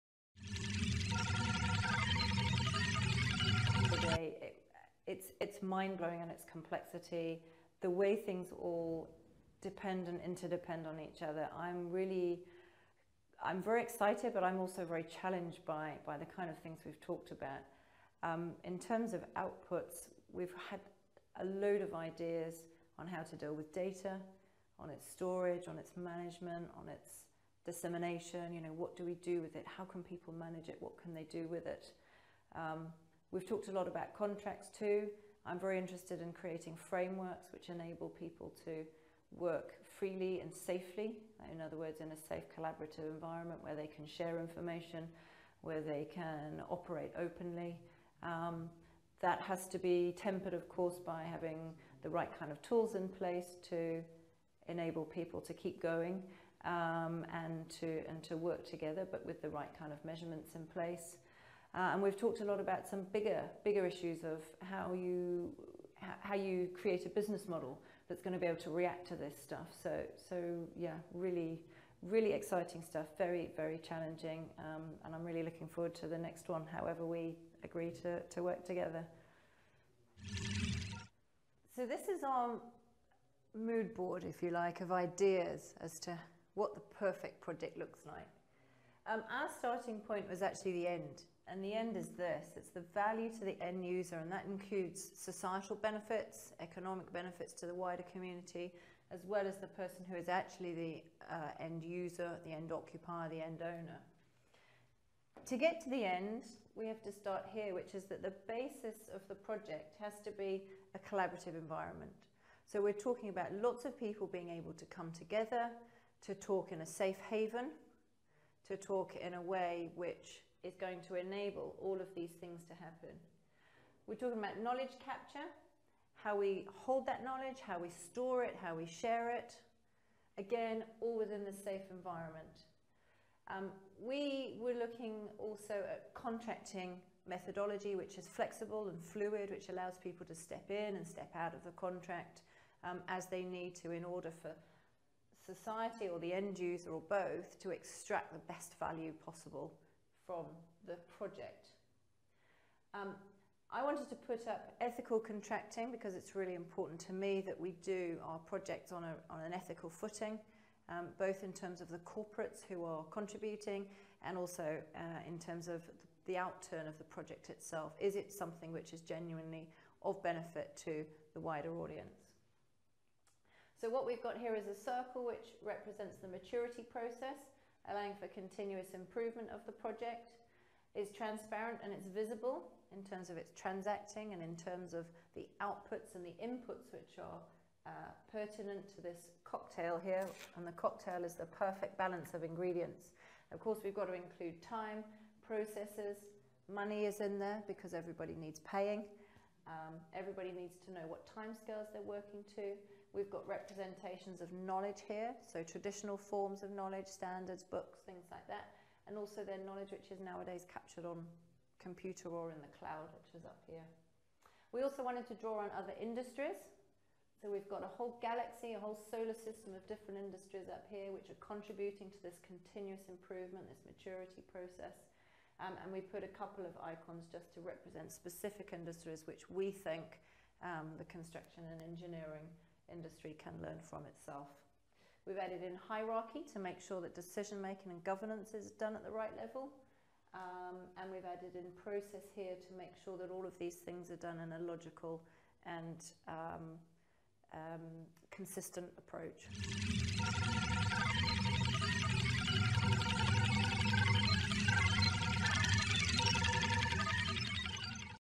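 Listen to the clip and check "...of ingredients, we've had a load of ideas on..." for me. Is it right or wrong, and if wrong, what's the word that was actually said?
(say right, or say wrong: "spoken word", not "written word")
wrong: "outputs", not "ingredients".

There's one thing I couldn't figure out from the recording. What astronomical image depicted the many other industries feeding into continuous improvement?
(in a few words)
solar system.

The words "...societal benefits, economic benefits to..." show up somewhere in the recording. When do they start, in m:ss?
1:35.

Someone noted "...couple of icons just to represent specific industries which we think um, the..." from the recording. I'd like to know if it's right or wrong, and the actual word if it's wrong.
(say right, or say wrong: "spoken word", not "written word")
right.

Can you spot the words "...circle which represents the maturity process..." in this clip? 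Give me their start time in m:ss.
2:54.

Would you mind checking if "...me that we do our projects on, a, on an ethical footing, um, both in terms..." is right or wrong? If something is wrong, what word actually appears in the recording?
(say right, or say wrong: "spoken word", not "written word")
right.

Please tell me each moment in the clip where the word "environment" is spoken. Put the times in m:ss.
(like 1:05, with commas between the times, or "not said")
0:43, 1:51, 2:11.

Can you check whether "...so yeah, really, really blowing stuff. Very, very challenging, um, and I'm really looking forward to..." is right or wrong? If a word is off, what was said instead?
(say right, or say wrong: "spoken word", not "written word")
wrong: "exciting", not "blowing".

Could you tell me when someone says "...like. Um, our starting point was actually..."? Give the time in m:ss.
1:28.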